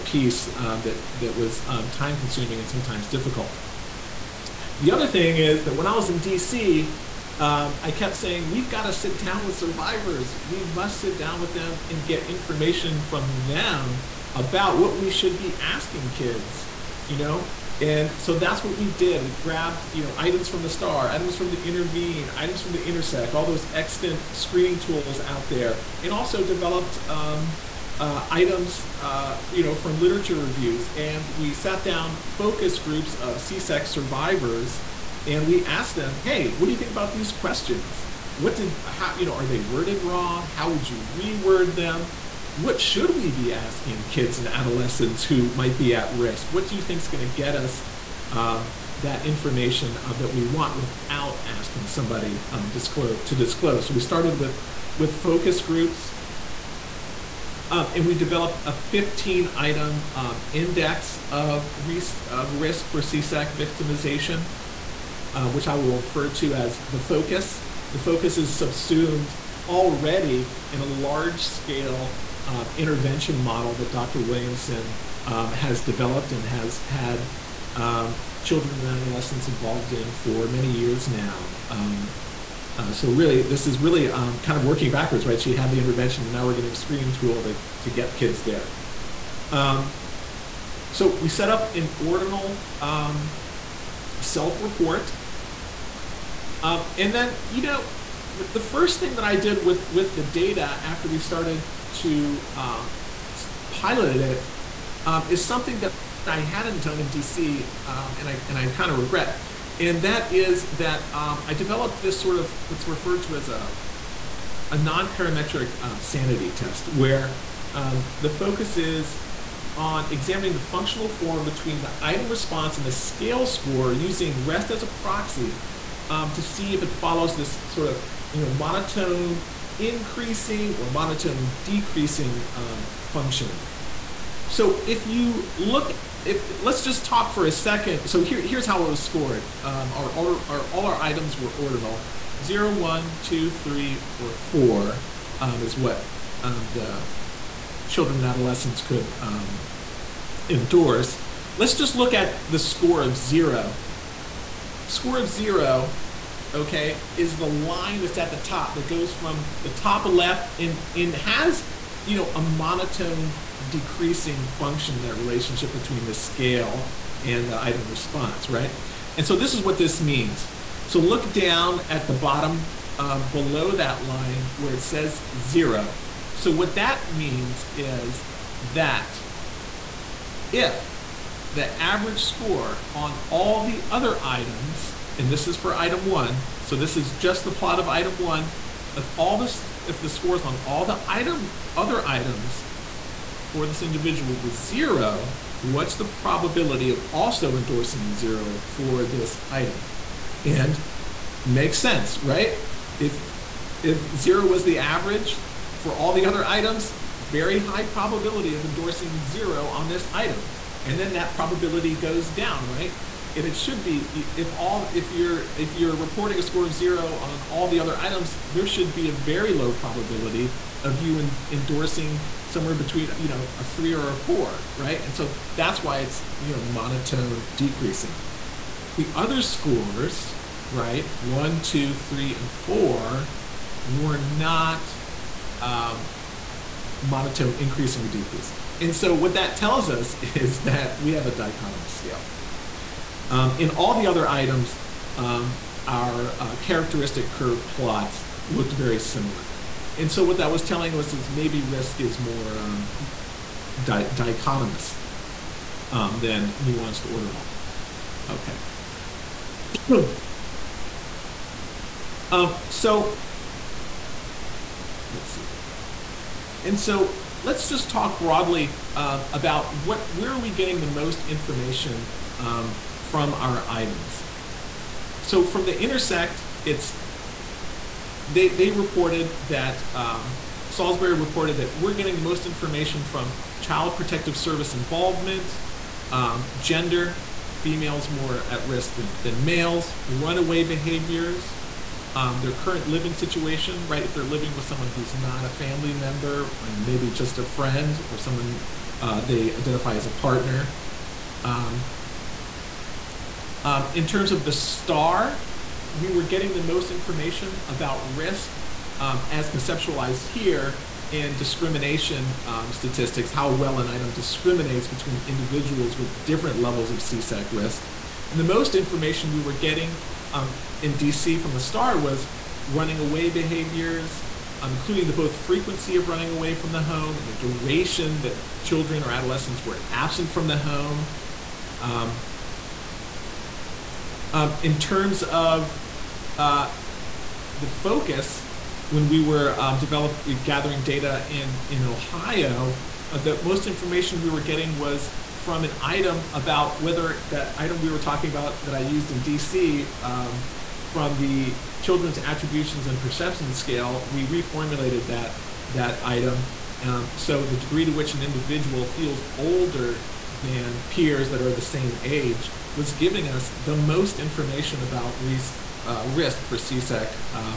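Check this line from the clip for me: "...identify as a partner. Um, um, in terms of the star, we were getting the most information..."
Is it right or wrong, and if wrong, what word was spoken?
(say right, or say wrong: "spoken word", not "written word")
right.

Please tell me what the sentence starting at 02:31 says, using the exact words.
Let's just look at the score of zero.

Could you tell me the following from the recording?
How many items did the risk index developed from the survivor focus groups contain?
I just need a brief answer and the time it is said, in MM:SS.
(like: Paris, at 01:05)
15, at 00:58.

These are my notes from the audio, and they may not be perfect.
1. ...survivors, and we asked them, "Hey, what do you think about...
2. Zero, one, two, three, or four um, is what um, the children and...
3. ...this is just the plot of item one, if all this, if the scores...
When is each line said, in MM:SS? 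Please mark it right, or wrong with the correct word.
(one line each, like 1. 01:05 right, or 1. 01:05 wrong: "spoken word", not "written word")
1. 00:33 right
2. 02:22 right
3. 03:06 right.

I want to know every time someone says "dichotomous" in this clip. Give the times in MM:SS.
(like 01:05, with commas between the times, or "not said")
04:01, 04:14.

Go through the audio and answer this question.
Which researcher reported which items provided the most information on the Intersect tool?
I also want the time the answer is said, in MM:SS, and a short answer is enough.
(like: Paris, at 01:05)
Salisbury, at 04:40.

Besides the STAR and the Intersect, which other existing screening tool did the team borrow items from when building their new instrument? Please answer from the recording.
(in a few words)
Intervene.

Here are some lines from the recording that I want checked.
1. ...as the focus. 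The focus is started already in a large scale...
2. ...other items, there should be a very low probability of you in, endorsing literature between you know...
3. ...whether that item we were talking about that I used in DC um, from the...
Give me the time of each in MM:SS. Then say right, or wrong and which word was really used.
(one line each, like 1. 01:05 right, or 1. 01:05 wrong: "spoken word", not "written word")
1. 01:06 wrong: "subsumed", not "started"
2. 03:37 wrong: "somewhere", not "literature"
3. 05:46 right.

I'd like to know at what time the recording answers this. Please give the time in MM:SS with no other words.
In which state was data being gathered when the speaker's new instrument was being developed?
05:41.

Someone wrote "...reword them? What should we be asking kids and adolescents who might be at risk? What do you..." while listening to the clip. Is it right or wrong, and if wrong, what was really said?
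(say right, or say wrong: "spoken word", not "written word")
right.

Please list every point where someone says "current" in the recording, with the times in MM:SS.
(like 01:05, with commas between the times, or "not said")
04:52.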